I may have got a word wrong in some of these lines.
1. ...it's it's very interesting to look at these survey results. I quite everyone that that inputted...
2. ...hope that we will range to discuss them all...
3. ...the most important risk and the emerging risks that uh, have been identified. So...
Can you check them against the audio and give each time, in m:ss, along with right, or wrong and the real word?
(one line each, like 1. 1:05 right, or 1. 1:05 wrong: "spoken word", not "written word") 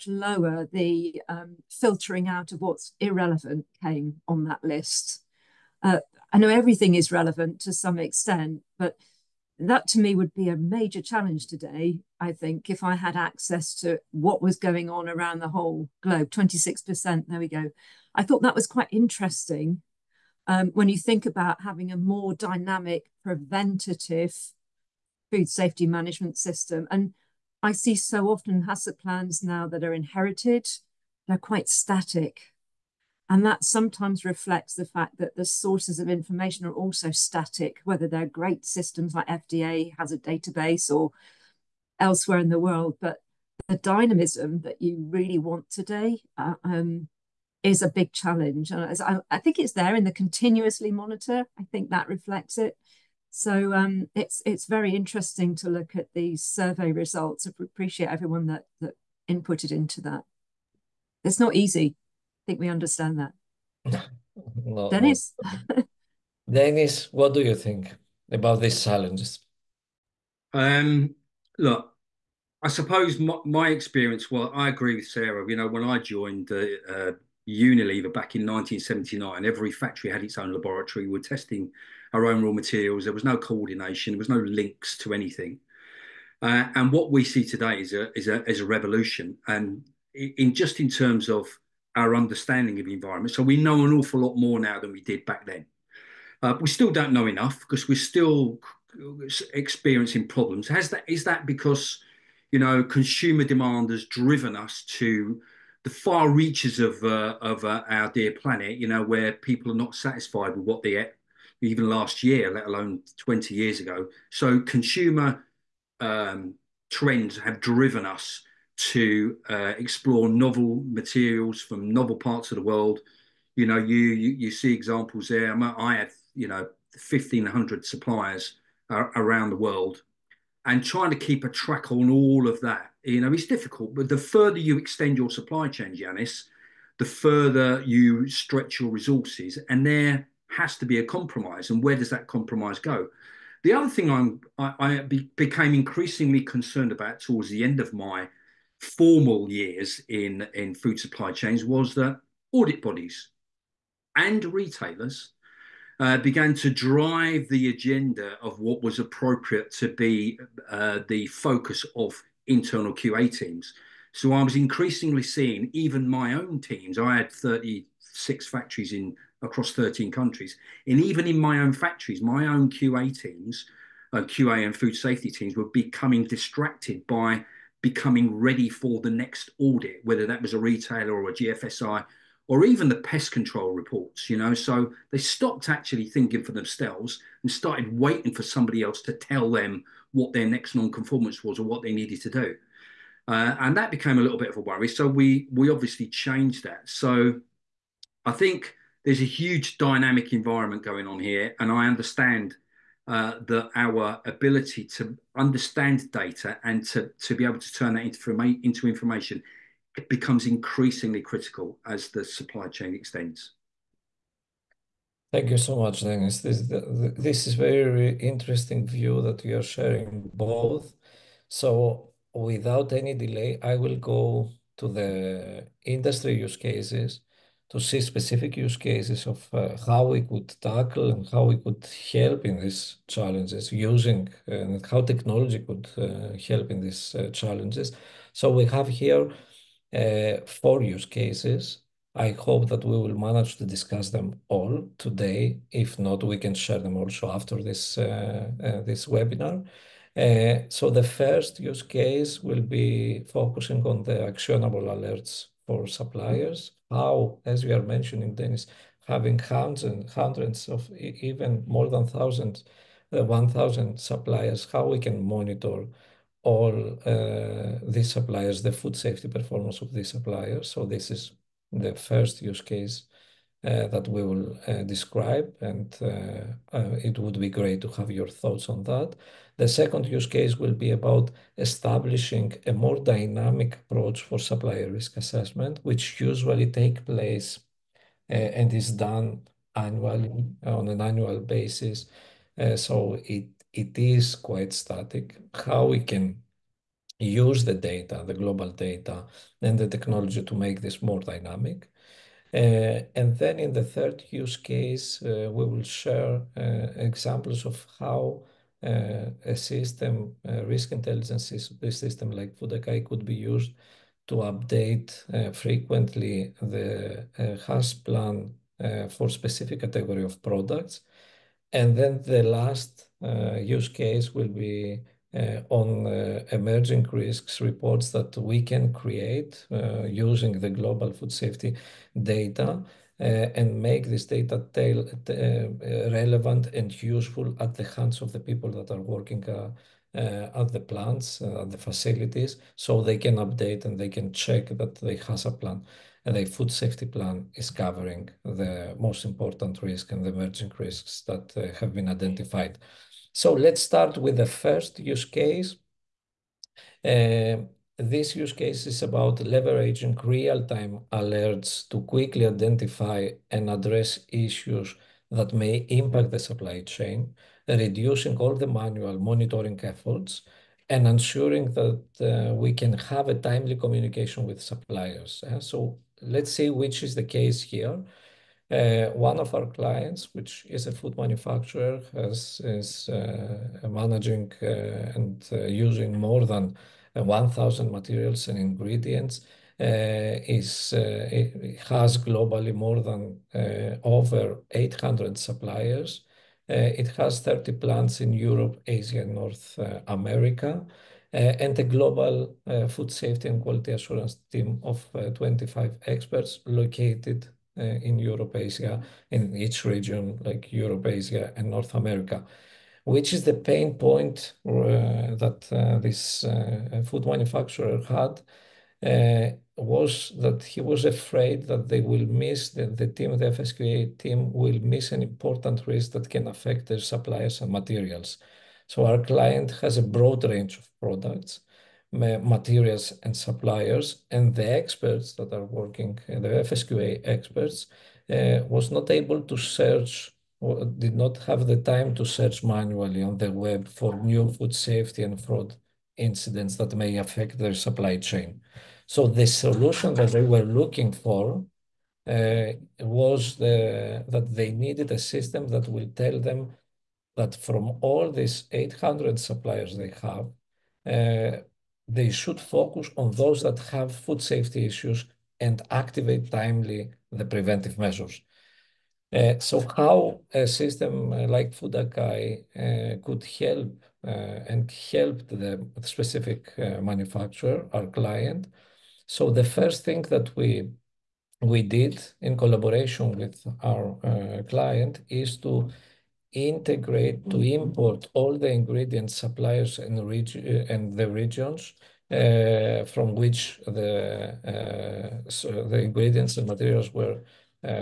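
1. 0:54 wrong: "appreciate", not "quite"
2. 4:02 wrong: "manage", not "range"
3. 5:48 right.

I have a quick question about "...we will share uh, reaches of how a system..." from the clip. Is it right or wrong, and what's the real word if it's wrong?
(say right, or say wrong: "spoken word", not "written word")
wrong: "examples", not "reaches".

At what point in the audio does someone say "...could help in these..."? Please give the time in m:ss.
3:51.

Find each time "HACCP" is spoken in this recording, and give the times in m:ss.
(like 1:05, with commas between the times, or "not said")
0:28, 5:17.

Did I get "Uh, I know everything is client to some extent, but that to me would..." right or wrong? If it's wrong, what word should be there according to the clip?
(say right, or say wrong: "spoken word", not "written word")
wrong: "relevant", not "client".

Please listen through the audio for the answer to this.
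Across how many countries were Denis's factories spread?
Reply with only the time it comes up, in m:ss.
2:49.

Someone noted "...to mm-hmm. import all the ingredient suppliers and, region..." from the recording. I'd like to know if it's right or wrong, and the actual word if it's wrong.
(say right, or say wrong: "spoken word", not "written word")
right.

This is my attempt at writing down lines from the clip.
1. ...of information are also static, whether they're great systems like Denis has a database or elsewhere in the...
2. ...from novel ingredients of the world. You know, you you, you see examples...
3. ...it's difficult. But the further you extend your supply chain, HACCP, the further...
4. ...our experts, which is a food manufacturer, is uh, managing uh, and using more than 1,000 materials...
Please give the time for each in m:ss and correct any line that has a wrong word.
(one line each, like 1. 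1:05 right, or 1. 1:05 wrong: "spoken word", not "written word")
1. 0:35 wrong: "FDA", not "Denis"
2. 2:01 wrong: "parts", not "ingredients"
3. 2:13 wrong: "Giannis", not "HACCP"
4. 6:19 wrong: "clients", not "experts".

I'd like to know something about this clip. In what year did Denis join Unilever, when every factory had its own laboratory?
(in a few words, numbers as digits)
1979.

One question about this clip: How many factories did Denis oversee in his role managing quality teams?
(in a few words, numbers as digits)
36.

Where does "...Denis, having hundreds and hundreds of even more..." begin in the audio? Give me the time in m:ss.
4:18.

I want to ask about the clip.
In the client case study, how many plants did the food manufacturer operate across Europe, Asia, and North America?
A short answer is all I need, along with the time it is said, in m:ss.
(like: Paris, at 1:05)
30, at 6:37.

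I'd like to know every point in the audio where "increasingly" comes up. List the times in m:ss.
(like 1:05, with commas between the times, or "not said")
2:25, 2:44, 3:30.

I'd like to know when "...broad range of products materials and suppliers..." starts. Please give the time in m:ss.
7:10.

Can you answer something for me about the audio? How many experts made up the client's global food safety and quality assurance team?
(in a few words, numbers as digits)
25.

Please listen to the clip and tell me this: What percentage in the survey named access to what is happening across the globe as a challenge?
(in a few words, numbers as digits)
26%.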